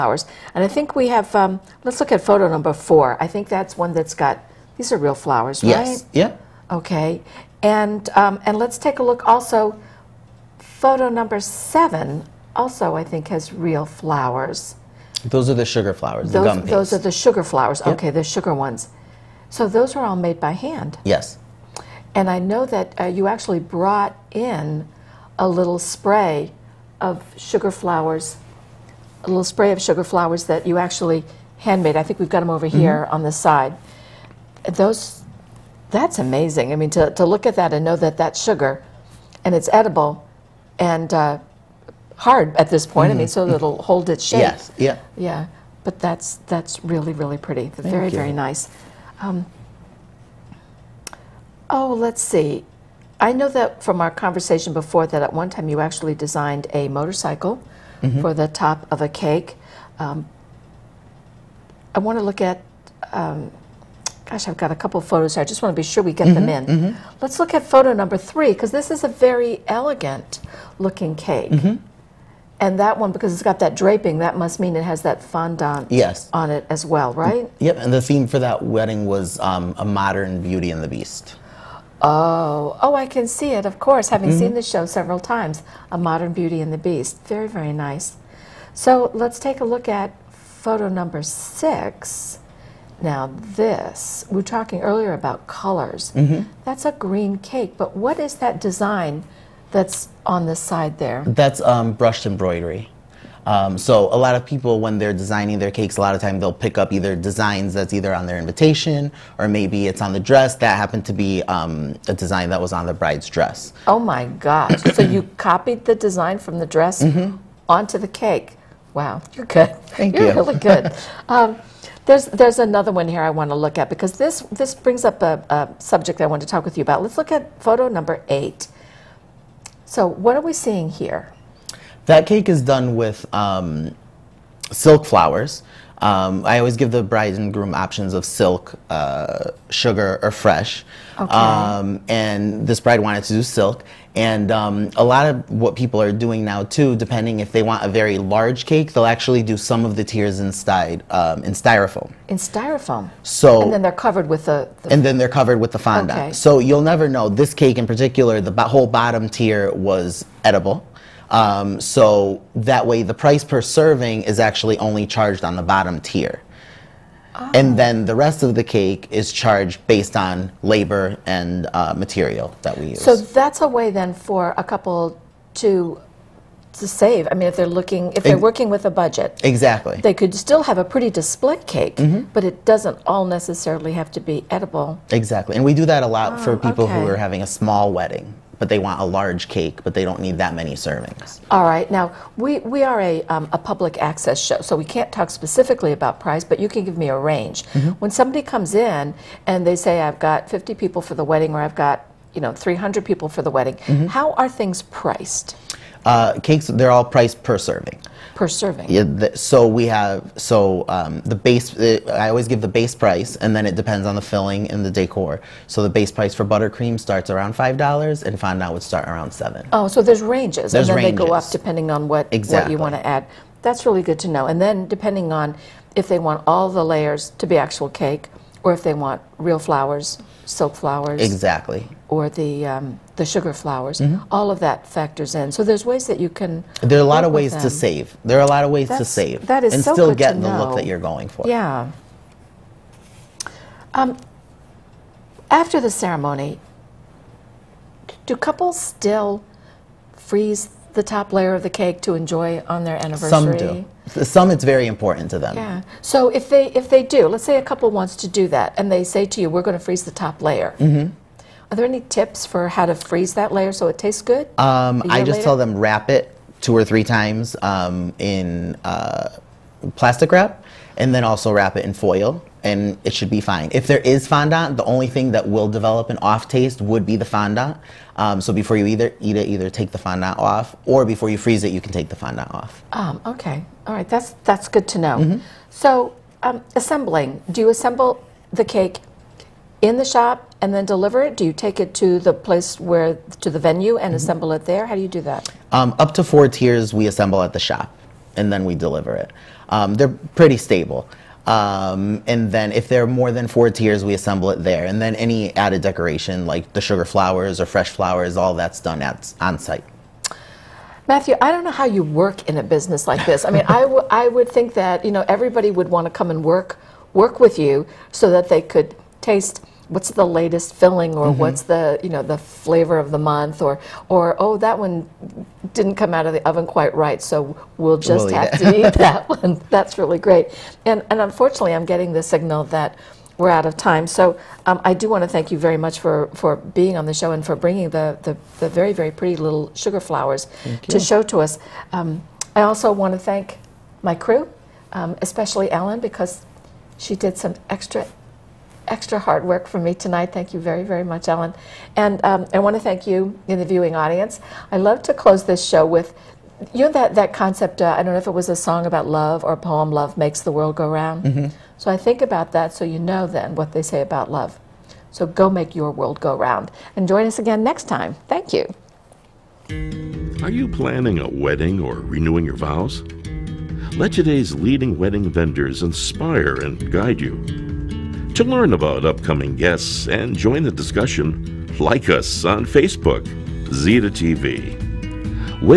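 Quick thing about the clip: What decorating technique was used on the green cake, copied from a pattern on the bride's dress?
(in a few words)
Brushed embroidery.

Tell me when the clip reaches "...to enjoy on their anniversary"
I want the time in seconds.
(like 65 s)
252 s.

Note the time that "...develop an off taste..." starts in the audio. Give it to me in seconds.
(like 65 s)
275 s.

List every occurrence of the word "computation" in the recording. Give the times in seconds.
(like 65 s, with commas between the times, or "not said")
not said.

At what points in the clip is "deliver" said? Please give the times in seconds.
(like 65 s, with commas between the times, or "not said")
290 s, 298 s.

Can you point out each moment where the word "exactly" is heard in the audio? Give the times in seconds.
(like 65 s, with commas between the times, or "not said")
179 s, 185 s, 222 s, 231 s.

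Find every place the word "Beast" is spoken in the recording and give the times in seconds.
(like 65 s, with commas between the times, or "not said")
80 s, 86 s.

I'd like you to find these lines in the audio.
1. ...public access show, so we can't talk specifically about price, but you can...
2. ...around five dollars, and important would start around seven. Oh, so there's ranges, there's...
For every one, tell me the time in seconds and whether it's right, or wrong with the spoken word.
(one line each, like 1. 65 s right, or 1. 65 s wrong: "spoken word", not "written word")
1. 193 s right
2. 217 s wrong: "fondant", not "important".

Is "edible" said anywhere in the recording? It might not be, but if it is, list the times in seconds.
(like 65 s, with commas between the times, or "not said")
39 s, 160 s, 184 s.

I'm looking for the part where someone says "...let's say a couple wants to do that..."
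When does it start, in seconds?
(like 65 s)
257 s.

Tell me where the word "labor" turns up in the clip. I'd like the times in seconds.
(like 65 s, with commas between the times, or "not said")
170 s.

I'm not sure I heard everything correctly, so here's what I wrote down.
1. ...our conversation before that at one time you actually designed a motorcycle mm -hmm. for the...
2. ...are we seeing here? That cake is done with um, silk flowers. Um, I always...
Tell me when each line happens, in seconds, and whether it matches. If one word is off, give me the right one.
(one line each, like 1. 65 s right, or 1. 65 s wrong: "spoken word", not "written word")
1. 54 s right
2. 130 s right.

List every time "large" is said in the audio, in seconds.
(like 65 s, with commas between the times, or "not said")
148 s, 189 s.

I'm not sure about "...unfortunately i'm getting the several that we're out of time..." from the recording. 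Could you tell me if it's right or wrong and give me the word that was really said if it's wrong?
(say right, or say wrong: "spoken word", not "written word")
wrong: "signal", not "several".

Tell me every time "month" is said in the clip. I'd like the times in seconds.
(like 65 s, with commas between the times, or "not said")
323 s.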